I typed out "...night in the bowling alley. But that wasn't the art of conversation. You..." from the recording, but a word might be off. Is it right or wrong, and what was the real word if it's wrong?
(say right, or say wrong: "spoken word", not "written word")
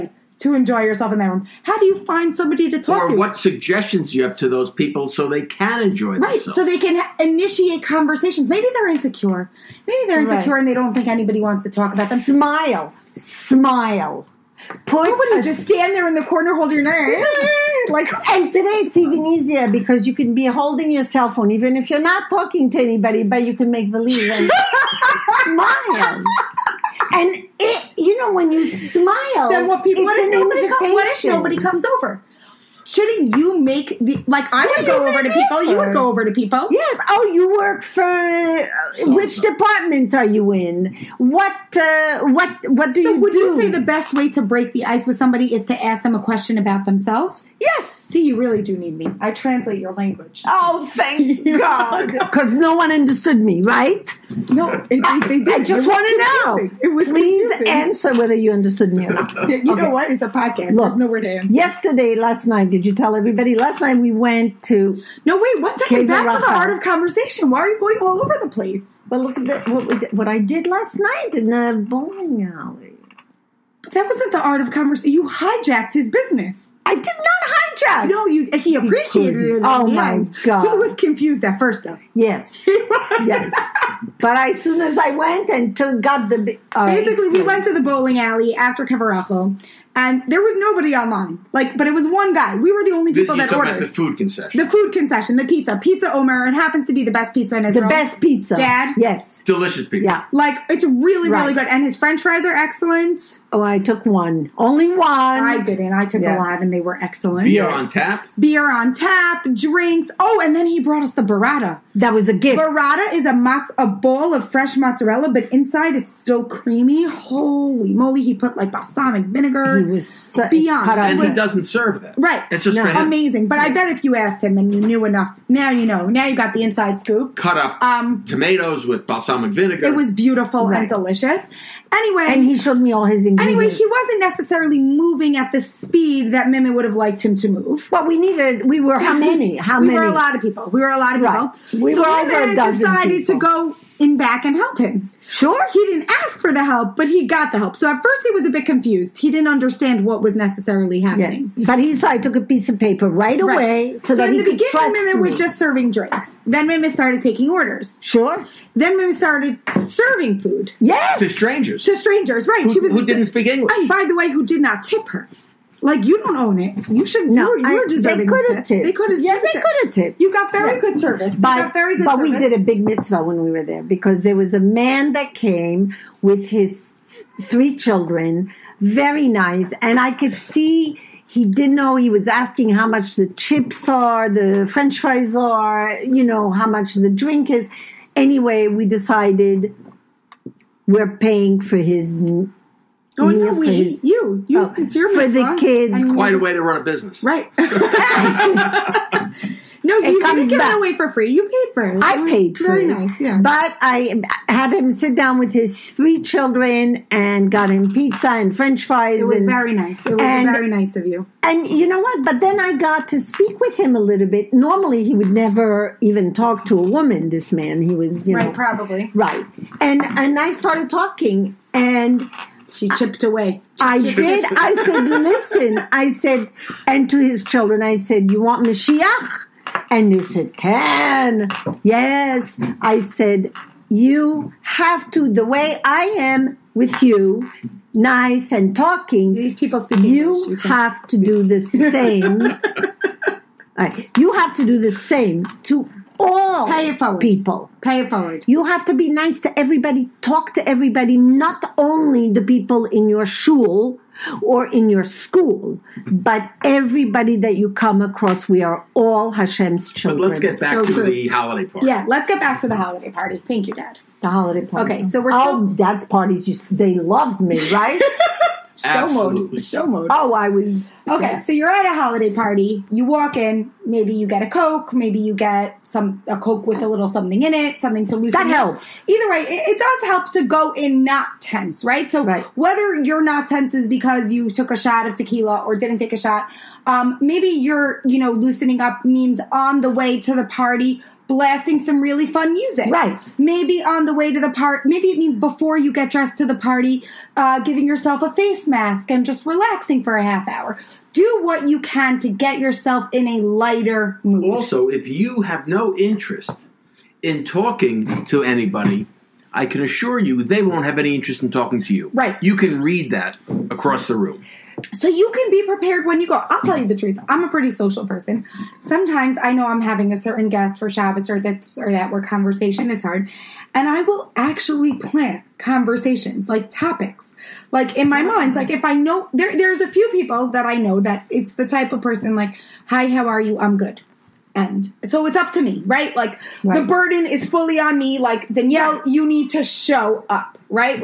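right.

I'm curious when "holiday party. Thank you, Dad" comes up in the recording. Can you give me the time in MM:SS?
04:22.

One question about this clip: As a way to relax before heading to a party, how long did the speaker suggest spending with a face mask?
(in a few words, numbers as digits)
A half hour.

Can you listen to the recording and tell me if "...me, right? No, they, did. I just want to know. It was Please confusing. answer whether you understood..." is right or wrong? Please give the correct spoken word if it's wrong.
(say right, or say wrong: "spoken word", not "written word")
right.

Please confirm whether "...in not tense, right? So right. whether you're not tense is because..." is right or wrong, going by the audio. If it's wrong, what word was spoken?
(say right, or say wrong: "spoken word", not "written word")
right.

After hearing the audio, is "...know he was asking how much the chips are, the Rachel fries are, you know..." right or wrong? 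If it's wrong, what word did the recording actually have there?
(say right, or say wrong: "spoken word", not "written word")
wrong: "French", not "Rachel".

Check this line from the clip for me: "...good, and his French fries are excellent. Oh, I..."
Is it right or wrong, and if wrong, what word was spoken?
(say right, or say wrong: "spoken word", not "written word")
right.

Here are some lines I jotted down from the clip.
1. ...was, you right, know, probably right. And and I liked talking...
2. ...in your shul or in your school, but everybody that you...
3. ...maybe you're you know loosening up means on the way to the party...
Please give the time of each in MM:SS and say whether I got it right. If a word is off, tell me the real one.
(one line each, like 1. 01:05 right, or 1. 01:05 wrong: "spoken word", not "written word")
1. 03:37 wrong: "started", not "liked"
2. 04:12 right
3. 04:47 right.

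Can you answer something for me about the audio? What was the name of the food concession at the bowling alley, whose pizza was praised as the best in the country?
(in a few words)
Pizza Omer.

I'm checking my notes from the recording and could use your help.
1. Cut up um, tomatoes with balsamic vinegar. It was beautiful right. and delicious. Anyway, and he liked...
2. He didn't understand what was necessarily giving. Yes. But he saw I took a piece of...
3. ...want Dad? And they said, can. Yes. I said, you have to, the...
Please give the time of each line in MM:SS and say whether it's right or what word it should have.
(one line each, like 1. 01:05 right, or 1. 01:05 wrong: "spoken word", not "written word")
1. 02:07 wrong: "showed", not "liked"
2. 02:29 wrong: "happening", not "giving"
3. 03:48 wrong: "Mashiach", not "Dad".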